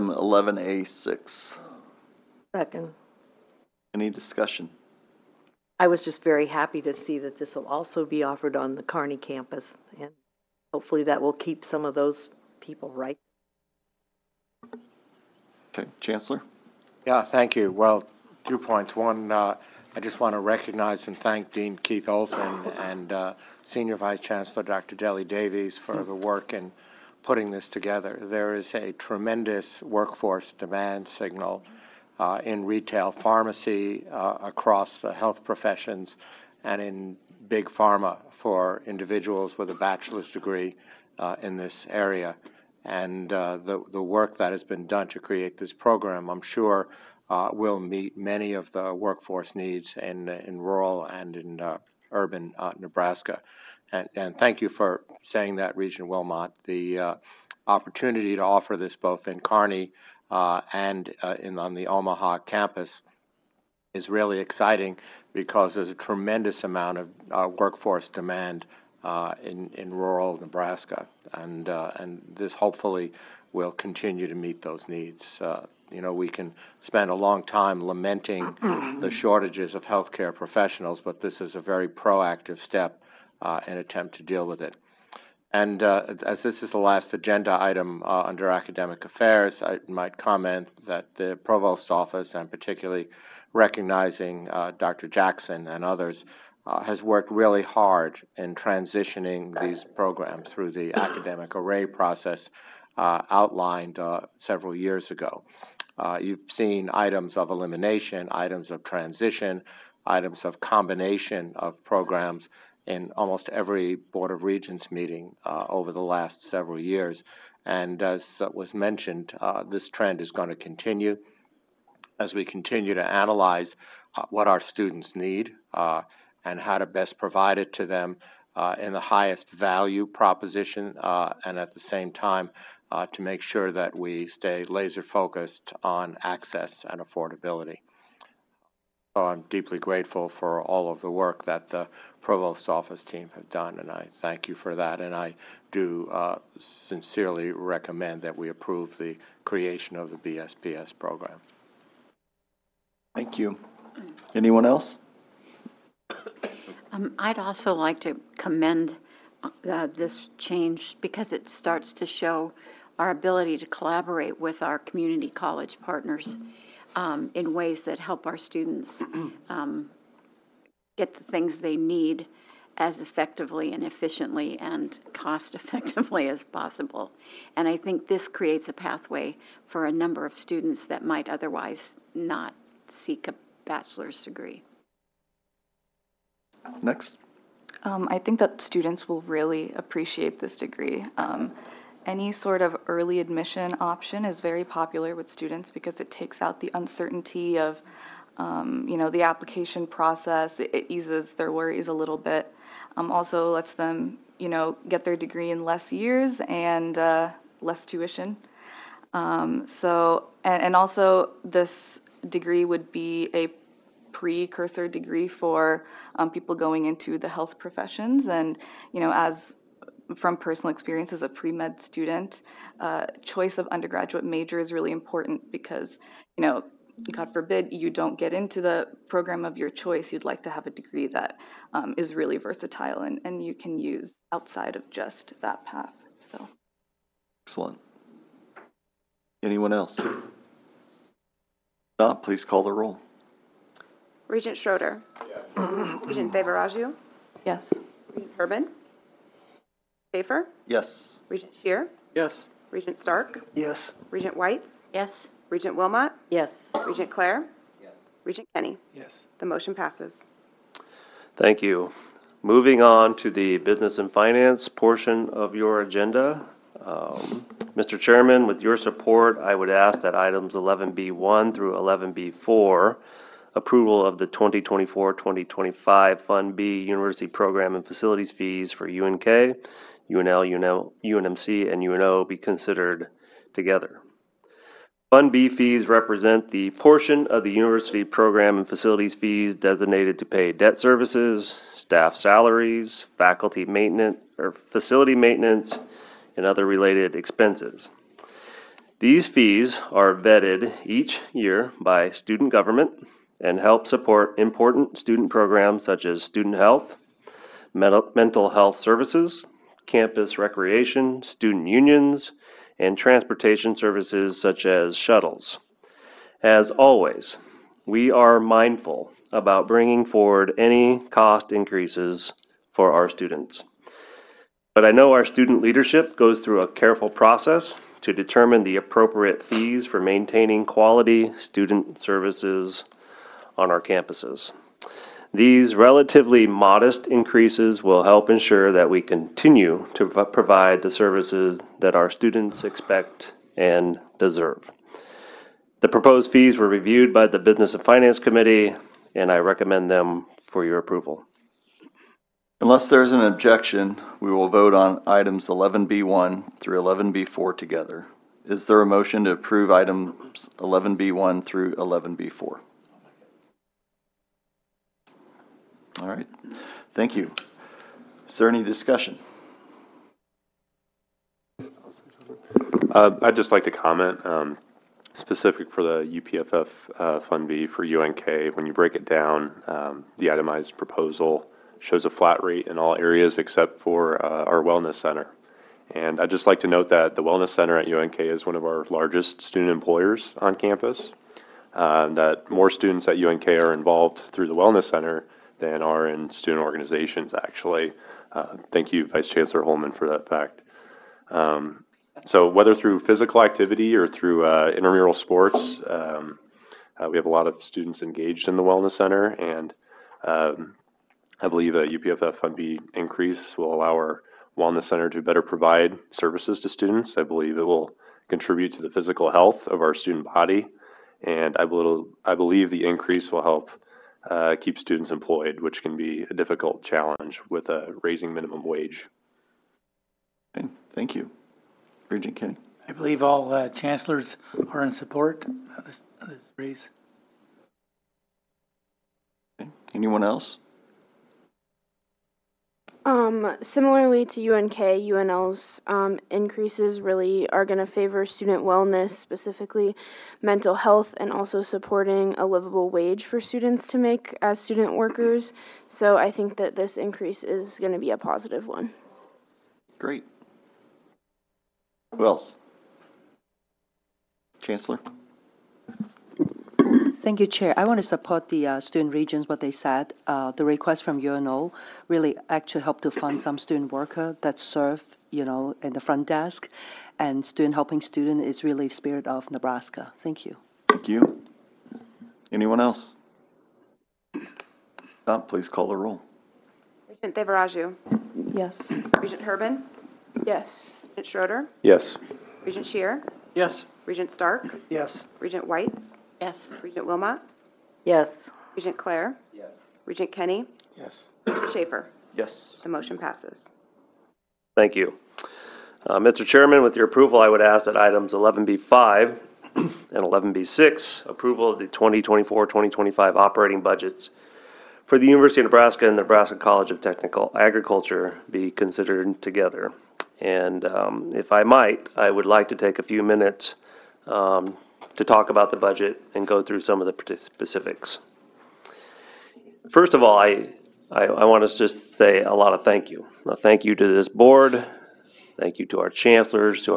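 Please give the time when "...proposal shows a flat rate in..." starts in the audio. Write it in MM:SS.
06:20.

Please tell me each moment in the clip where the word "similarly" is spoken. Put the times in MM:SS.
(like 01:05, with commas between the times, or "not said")
07:23.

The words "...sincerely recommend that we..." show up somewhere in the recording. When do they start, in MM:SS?
02:26.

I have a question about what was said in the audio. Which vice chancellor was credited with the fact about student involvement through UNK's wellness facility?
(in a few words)
Vice Chancellor Holman.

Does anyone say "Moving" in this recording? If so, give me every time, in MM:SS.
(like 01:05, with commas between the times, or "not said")
04:22.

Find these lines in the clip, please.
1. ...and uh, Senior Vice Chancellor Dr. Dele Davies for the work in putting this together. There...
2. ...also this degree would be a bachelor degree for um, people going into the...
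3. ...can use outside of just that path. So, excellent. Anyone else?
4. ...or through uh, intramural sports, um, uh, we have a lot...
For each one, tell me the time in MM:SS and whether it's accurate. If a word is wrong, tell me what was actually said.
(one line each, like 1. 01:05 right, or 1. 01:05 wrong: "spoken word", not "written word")
1. 00:22 right
2. 03:30 wrong: "precursor", not "bachelor"
3. 03:53 right
4. 06:43 right.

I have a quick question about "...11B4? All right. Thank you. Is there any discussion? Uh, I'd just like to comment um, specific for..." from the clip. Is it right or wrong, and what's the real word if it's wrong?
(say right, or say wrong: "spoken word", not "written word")
right.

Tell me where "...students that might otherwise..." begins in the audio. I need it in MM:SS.
03:00.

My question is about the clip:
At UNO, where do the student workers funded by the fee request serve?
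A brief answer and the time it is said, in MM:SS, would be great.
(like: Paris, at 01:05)
front desk, at 07:56.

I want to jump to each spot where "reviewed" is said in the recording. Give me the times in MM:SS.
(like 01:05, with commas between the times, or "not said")
05:46.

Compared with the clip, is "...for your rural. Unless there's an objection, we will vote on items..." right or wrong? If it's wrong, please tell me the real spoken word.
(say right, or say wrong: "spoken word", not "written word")
wrong: "approval", not "rural".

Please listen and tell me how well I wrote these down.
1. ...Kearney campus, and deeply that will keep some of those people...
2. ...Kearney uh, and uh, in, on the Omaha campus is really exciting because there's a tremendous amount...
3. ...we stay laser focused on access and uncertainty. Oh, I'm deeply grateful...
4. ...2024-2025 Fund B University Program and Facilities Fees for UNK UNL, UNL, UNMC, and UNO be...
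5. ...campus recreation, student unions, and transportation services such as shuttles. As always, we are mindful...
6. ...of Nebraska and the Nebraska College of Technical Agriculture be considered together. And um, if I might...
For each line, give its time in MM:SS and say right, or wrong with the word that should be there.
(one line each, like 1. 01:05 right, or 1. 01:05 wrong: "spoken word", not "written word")
1. 00:08 wrong: "hopefully", not "deeply"
2. 00:59 right
3. 02:13 wrong: "affordability", not "uncertainty"
4. 04:34 right
5. 05:09 right
6. 08:35 right.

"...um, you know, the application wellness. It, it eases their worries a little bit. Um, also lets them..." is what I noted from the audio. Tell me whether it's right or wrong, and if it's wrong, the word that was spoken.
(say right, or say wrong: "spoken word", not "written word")
wrong: "process", not "wellness".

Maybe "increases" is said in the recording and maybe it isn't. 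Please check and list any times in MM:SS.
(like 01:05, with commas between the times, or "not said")
05:21, 05:37, 06:52, 07:02, 07:26, 07:36.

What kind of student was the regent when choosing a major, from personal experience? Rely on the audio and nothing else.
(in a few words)
pre med student.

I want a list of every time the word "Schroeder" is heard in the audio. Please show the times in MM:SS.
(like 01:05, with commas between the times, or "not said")
04:04, 08:11.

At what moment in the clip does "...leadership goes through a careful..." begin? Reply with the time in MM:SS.
05:25.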